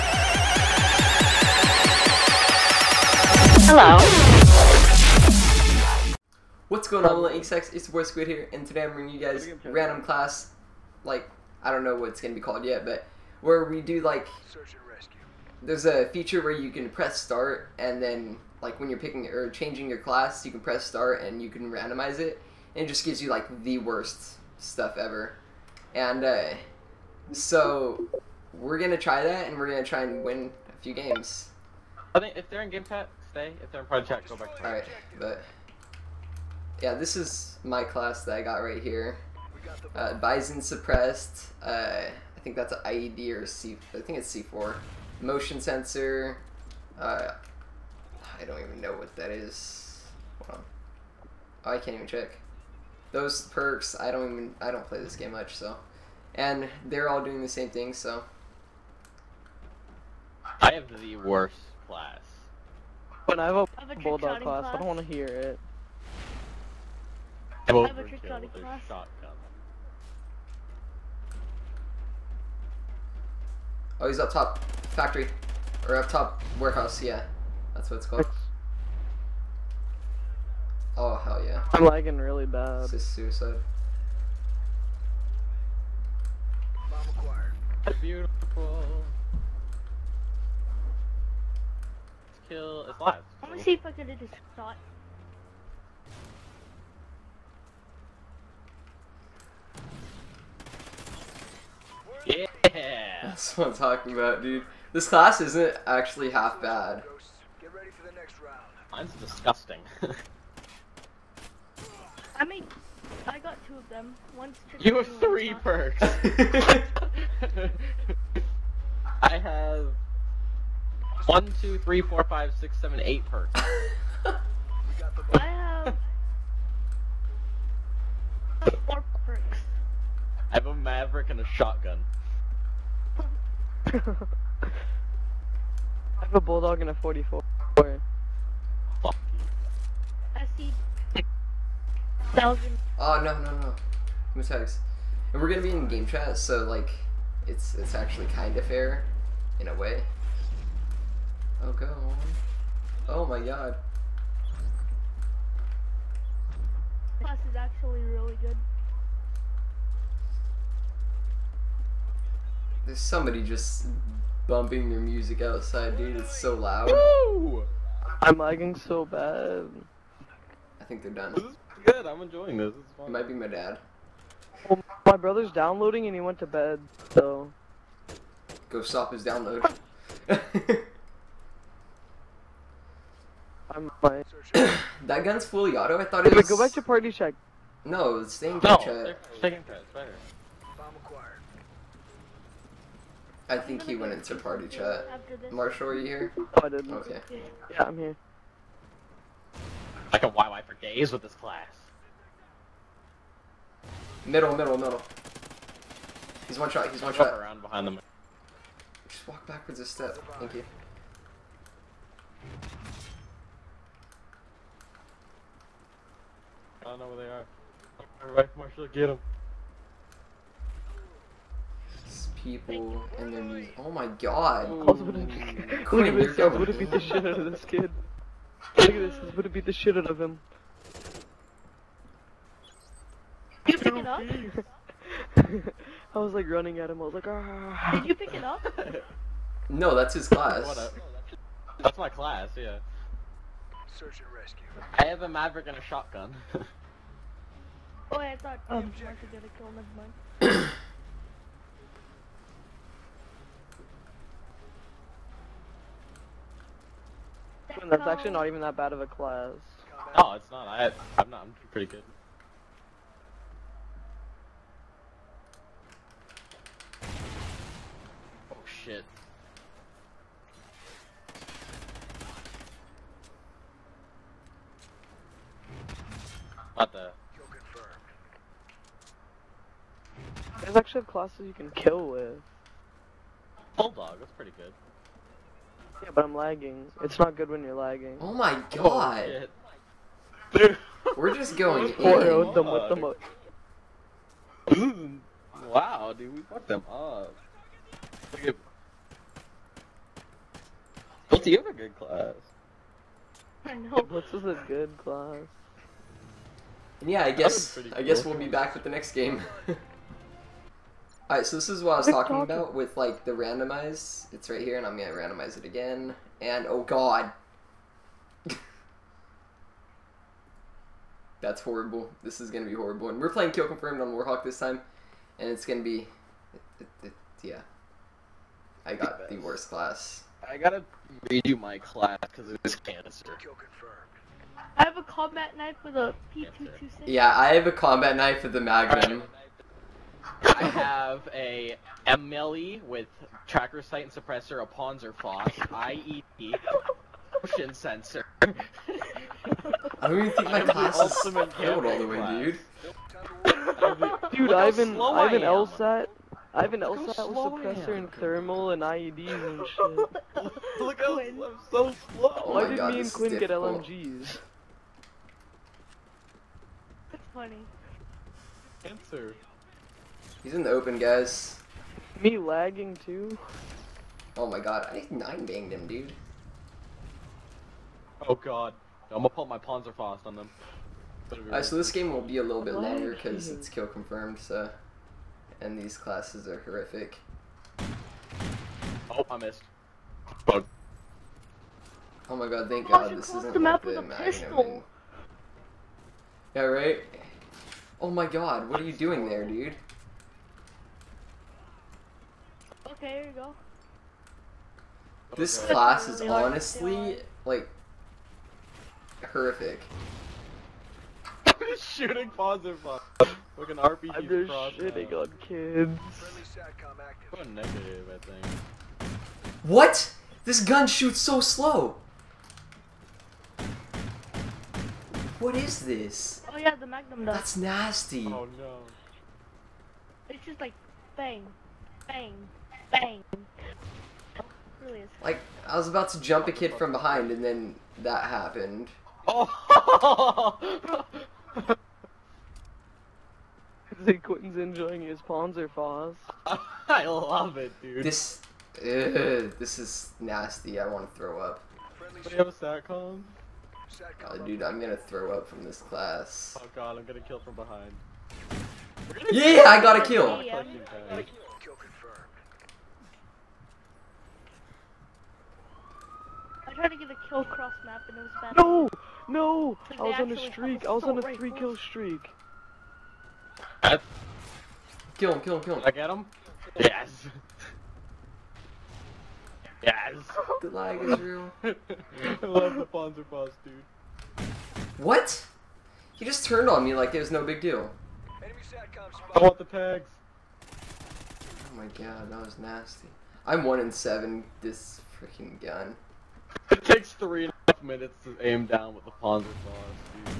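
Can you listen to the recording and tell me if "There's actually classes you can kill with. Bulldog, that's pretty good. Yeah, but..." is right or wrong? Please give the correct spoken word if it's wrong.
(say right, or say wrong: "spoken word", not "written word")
right.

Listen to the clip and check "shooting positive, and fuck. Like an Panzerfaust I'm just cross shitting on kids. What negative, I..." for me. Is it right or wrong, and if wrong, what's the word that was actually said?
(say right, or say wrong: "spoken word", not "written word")
wrong: "RPG", not "Panzerfaust".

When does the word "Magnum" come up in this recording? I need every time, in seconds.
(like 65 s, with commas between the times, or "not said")
338 s, 426 s.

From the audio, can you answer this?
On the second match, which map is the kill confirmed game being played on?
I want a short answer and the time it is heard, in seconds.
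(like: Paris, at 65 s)
Warhawk, at 324 s.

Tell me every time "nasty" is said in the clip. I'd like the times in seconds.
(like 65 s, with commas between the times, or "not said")
427 s, 450 s, 492 s.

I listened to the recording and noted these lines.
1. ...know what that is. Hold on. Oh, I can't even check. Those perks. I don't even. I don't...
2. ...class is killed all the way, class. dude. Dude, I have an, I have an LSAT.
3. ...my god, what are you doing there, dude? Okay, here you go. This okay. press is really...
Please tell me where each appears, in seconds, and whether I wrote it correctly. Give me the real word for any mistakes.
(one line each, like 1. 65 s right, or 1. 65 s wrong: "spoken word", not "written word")
1. 48 s right
2. 350 s right
3. 398 s wrong: "class", not "press".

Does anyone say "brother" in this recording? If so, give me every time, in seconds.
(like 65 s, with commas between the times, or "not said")
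175 s.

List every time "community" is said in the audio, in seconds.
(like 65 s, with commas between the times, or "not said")
not said.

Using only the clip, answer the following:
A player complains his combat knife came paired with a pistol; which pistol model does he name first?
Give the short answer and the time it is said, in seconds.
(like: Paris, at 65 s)
P226, at 336 s.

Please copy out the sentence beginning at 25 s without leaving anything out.
And, uh, so, we're going to try that, and we're going to try and win a few games.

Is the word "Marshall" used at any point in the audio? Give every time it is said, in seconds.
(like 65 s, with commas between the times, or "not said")
195 s, 218 s.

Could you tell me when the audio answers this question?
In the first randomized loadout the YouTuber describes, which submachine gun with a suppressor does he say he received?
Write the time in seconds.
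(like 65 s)
40 s.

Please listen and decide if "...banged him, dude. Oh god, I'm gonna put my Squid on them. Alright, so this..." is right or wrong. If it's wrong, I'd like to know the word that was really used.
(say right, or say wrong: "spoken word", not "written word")
wrong: "Panzerfaust", not "Squid".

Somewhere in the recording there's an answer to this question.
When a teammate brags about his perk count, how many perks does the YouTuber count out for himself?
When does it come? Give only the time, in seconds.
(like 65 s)
123 s.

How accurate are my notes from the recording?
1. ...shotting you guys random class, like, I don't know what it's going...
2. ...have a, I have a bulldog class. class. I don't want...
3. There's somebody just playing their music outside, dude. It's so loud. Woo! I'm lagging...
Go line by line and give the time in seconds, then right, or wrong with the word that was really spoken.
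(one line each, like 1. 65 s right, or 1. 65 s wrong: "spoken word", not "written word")
1. 8 s wrong: "bringing", not "shotting"
2. 63 s right
3. 162 s wrong: "bumping", not "playing".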